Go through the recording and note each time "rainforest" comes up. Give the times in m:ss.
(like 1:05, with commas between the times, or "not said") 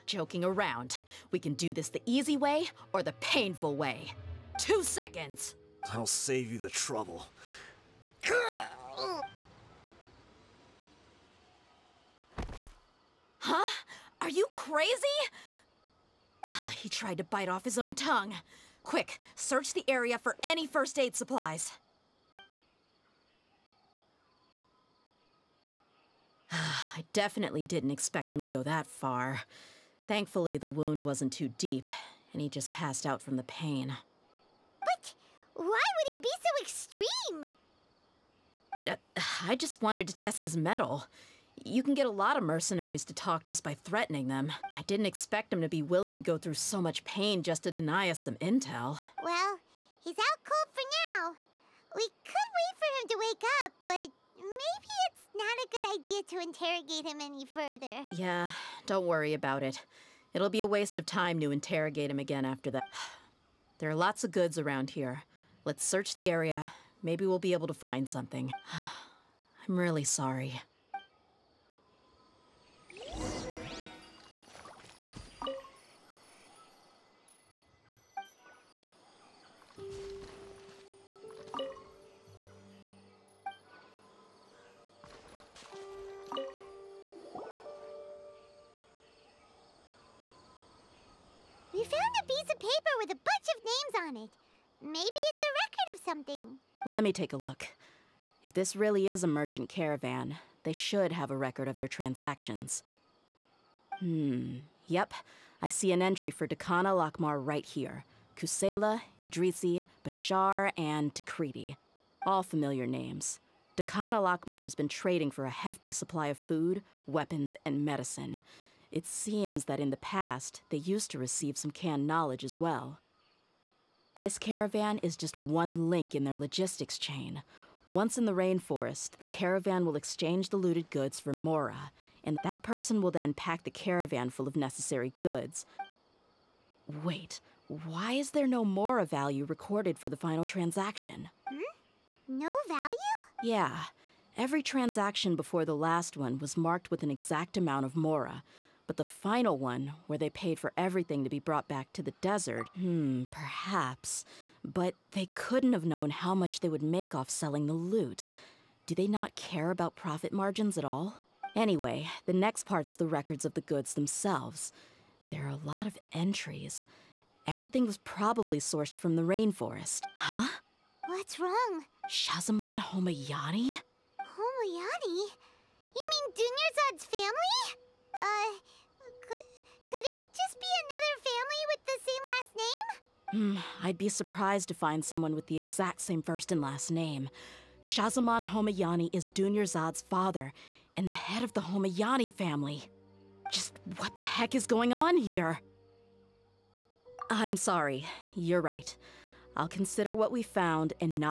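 2:08, 2:49.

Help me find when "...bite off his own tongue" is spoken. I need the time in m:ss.
0:17.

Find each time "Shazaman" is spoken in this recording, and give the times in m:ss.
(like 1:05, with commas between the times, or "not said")
2:52, 3:07.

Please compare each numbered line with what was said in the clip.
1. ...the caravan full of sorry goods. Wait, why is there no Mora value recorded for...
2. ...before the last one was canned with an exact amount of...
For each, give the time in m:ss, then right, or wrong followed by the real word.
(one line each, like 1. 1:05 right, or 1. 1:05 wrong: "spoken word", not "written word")
1. 2:13 wrong: "necessary", not "sorry"
2. 2:25 wrong: "marked", not "canned".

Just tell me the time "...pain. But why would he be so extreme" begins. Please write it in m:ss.
0:33.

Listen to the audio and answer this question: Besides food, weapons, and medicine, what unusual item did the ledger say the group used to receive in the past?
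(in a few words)
canned knowledge.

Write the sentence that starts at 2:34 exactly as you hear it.
But they couldn't have known how much they would make off selling the loot.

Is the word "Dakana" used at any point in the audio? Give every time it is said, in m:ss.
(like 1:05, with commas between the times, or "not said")
1:46, 1:53.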